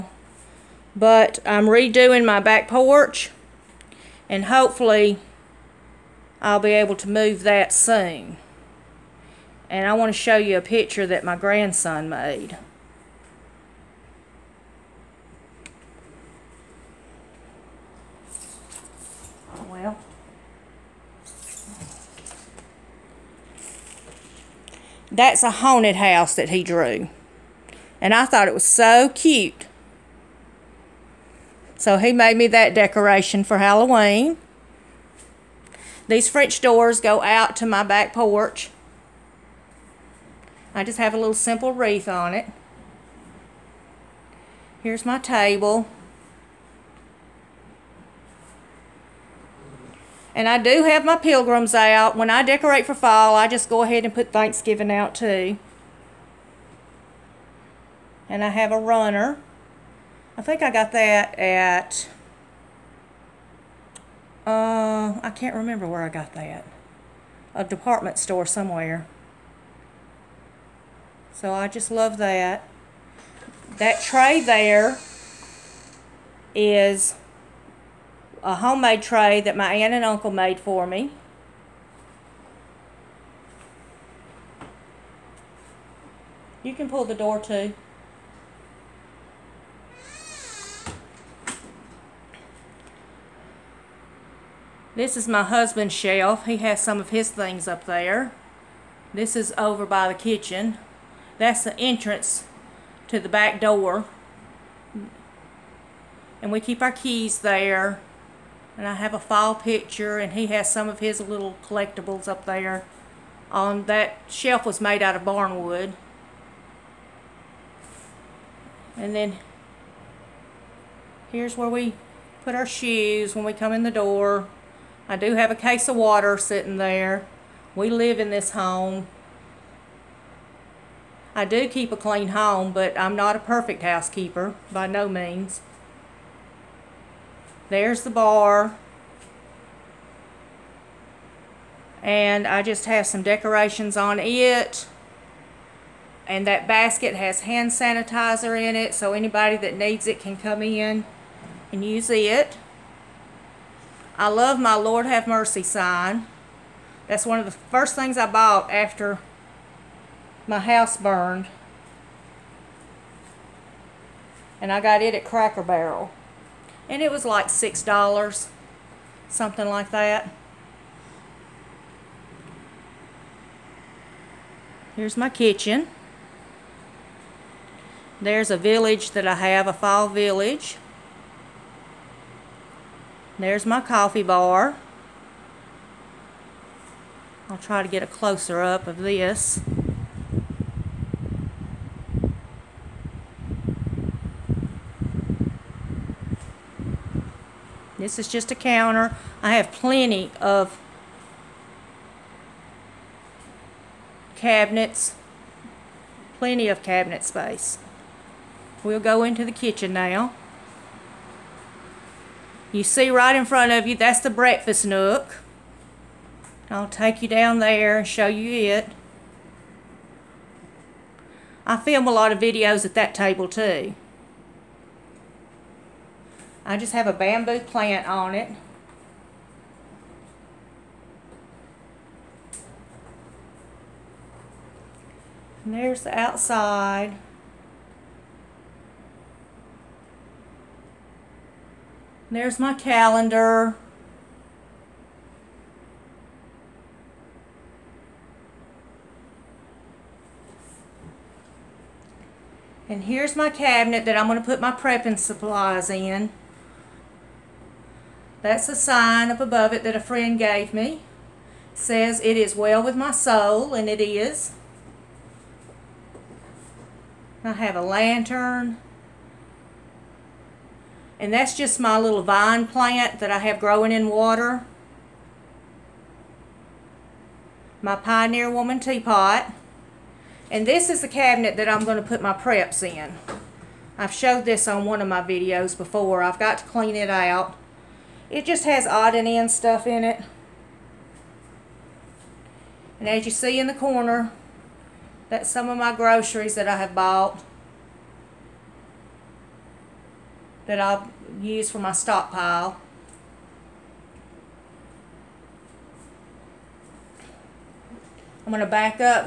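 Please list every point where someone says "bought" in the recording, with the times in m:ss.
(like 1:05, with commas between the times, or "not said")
2:38, 4:56.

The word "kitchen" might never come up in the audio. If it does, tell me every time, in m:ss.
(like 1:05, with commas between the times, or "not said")
1:40, 2:55, 3:29.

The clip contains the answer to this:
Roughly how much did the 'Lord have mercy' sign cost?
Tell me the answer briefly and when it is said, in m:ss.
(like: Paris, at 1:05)
$6, at 2:47.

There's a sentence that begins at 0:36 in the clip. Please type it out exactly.
These French doors go out to my back porch.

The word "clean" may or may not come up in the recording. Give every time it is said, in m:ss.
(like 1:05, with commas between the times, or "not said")
2:11, 4:46.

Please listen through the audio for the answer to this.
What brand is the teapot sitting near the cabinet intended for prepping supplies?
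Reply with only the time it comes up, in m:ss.
4:37.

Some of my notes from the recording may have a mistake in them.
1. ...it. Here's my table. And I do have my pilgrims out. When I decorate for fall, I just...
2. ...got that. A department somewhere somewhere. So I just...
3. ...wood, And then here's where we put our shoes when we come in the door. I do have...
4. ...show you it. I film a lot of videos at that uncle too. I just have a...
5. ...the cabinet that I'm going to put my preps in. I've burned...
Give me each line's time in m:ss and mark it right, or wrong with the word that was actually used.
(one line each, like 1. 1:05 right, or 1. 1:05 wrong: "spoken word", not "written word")
1. 0:42 right
2. 1:06 wrong: "store", not "somewhere"
3. 1:55 right
4. 3:38 wrong: "table", not "uncle"
5. 4:41 wrong: "showed", not "burned".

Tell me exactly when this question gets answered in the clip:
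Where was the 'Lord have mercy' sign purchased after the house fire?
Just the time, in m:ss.
2:45.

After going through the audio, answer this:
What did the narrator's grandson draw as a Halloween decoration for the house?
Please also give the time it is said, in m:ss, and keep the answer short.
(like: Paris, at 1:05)
A haunted house, at 0:25.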